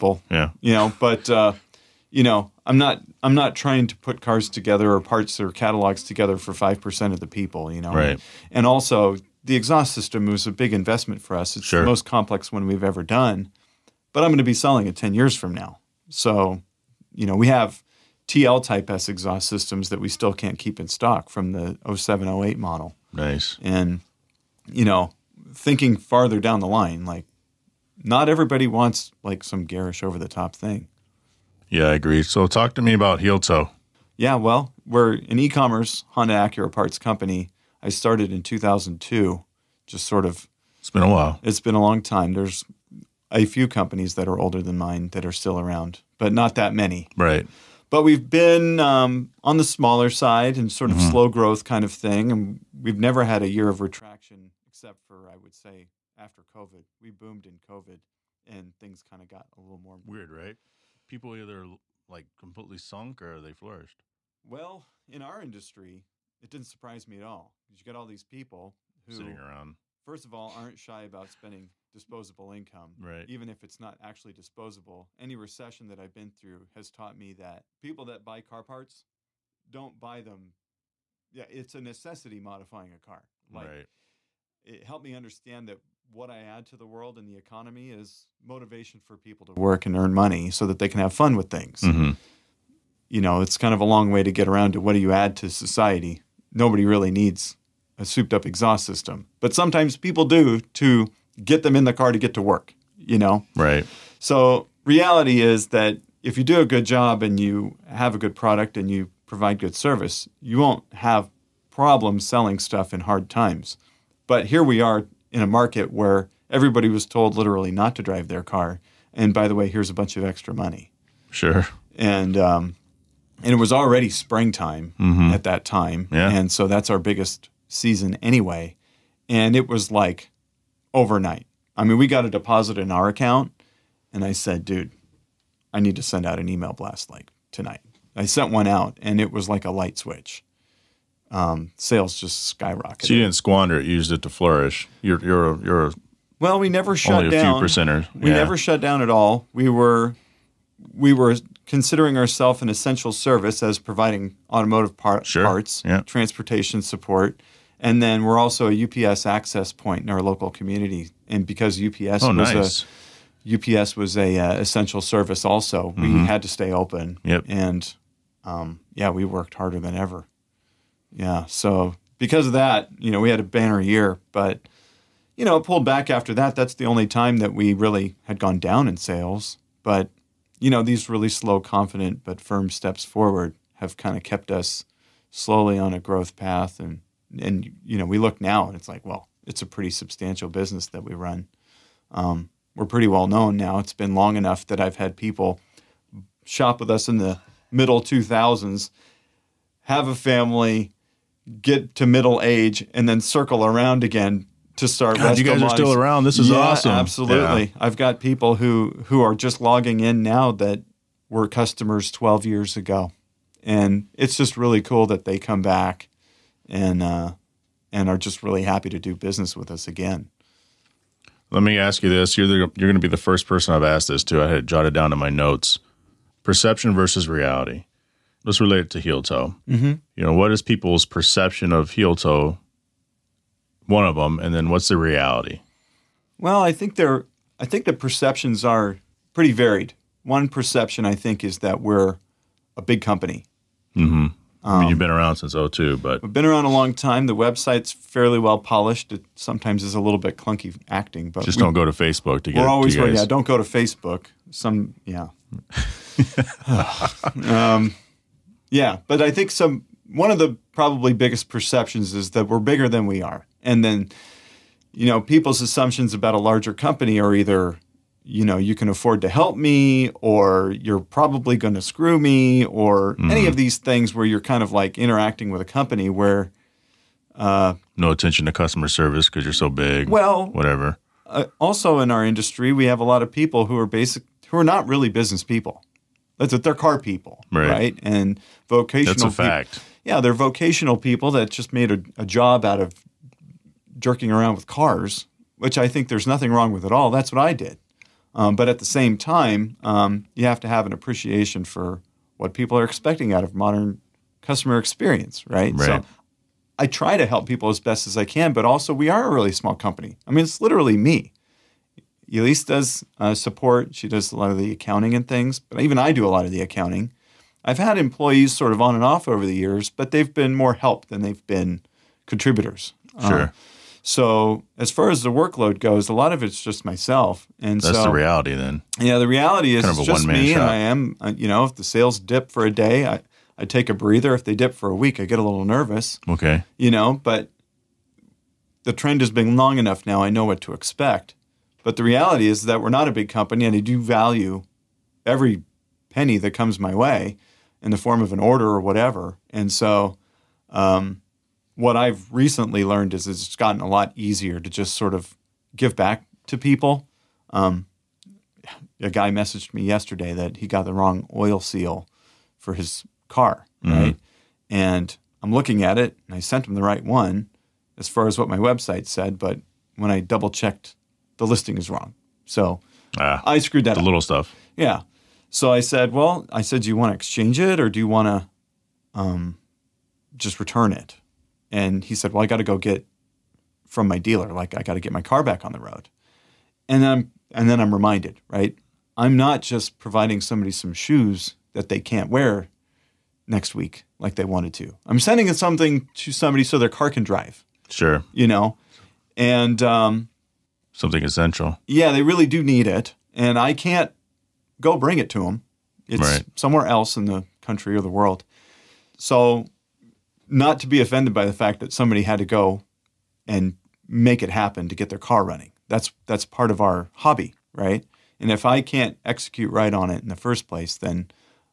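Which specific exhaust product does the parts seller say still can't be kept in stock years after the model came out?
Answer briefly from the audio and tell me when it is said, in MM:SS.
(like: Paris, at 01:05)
TL Type S exhaust systems, at 00:18.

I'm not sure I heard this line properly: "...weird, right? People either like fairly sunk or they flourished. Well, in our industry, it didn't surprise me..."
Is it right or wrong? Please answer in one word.
wrong.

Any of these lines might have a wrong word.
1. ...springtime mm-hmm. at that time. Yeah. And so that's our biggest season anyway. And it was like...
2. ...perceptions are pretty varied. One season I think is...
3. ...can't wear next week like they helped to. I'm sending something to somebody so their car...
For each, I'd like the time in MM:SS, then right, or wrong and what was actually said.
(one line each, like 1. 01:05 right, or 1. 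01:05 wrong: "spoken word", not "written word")
1. 02:04 right
2. 03:57 wrong: "perception", not "season"
3. 06:31 wrong: "wanted", not "helped".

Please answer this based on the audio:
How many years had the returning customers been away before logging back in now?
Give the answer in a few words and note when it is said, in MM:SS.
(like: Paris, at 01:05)
12, at 03:32.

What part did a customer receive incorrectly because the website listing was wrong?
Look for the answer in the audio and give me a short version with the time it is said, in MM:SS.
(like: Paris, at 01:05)
oil seal, at 06:01.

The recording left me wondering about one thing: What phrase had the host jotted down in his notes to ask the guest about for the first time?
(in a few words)
perception versus reality.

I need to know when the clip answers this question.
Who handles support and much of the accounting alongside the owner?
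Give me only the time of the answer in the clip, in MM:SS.
05:12.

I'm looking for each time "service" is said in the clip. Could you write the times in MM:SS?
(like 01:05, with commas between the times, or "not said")
01:49, 02:33, 02:45, 04:38.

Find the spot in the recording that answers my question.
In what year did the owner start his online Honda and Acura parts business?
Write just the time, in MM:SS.
00:38.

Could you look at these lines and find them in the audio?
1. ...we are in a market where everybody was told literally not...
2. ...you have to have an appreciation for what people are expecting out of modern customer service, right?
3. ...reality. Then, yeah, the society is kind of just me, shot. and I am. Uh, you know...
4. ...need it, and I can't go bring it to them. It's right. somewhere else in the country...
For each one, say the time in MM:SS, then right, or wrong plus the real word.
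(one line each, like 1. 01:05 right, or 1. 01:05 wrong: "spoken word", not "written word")
1. 01:54 right
2. 05:00 wrong: "experience", not "service"
3. 05:28 wrong: "reality", not "society"
4. 06:42 right.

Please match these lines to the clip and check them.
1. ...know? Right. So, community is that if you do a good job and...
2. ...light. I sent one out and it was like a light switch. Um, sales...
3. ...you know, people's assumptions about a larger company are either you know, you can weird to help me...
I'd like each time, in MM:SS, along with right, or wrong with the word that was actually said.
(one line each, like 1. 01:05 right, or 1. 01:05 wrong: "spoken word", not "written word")
1. 01:43 wrong: "reality", not "community"
2. 02:17 wrong: "tonight", not "light"
3. 04:24 wrong: "afford", not "weird".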